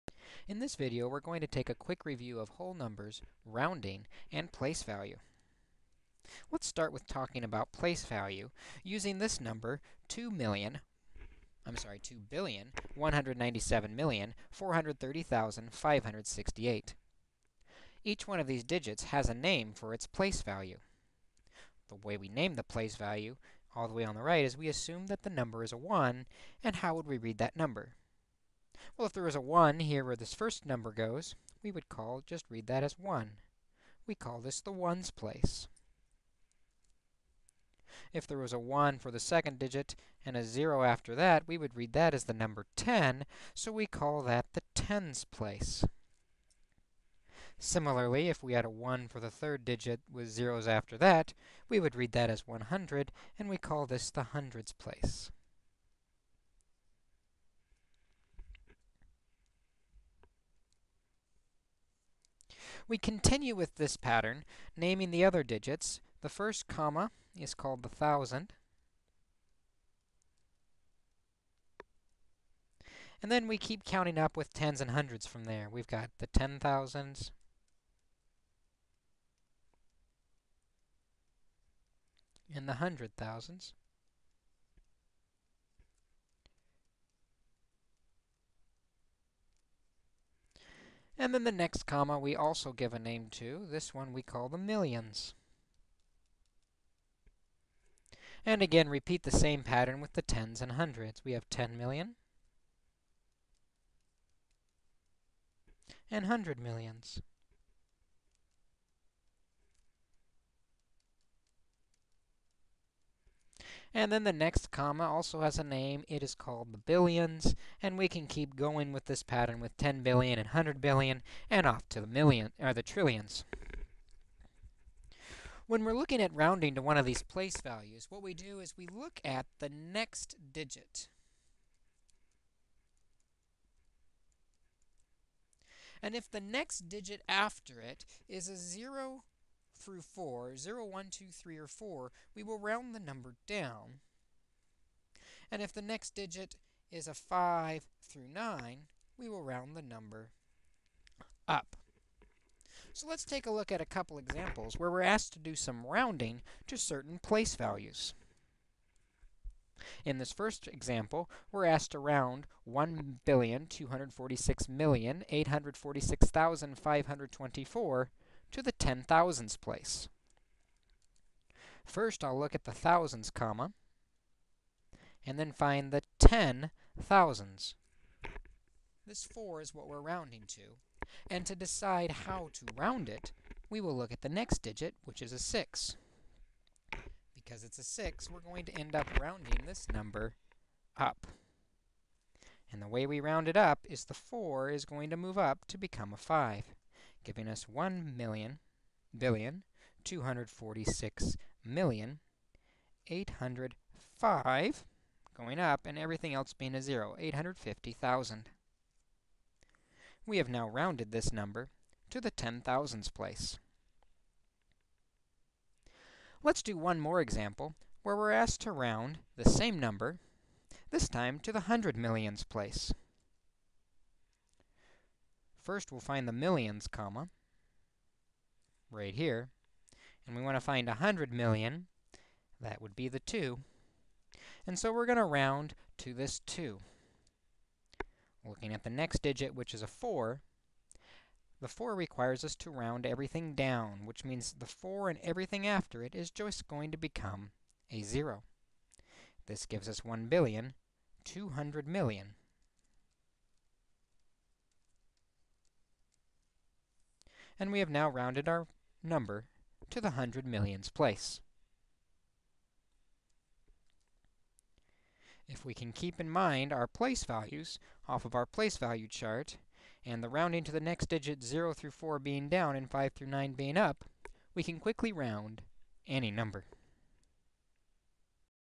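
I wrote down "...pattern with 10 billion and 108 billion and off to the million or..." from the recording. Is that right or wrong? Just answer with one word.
wrong.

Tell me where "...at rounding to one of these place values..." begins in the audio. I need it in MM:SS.
02:06.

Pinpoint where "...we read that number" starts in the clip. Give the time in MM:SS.
00:27.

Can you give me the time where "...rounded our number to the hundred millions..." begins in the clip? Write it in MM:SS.
04:18.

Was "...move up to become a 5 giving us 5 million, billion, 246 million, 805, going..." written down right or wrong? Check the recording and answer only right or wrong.
wrong.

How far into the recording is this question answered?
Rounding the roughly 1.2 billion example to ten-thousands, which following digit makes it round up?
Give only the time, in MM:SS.
03:05.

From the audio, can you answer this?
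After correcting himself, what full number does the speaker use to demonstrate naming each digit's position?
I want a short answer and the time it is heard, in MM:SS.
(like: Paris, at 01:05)
2,197,430,568, at 00:11.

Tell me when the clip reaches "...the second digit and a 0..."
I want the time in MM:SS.
00:39.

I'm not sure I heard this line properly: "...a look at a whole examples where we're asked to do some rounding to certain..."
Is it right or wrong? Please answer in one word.
wrong.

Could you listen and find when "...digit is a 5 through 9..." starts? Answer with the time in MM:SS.
02:26.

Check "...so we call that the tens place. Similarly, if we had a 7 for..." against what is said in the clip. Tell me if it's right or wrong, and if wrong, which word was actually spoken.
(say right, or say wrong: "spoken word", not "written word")
wrong: "1", not "7".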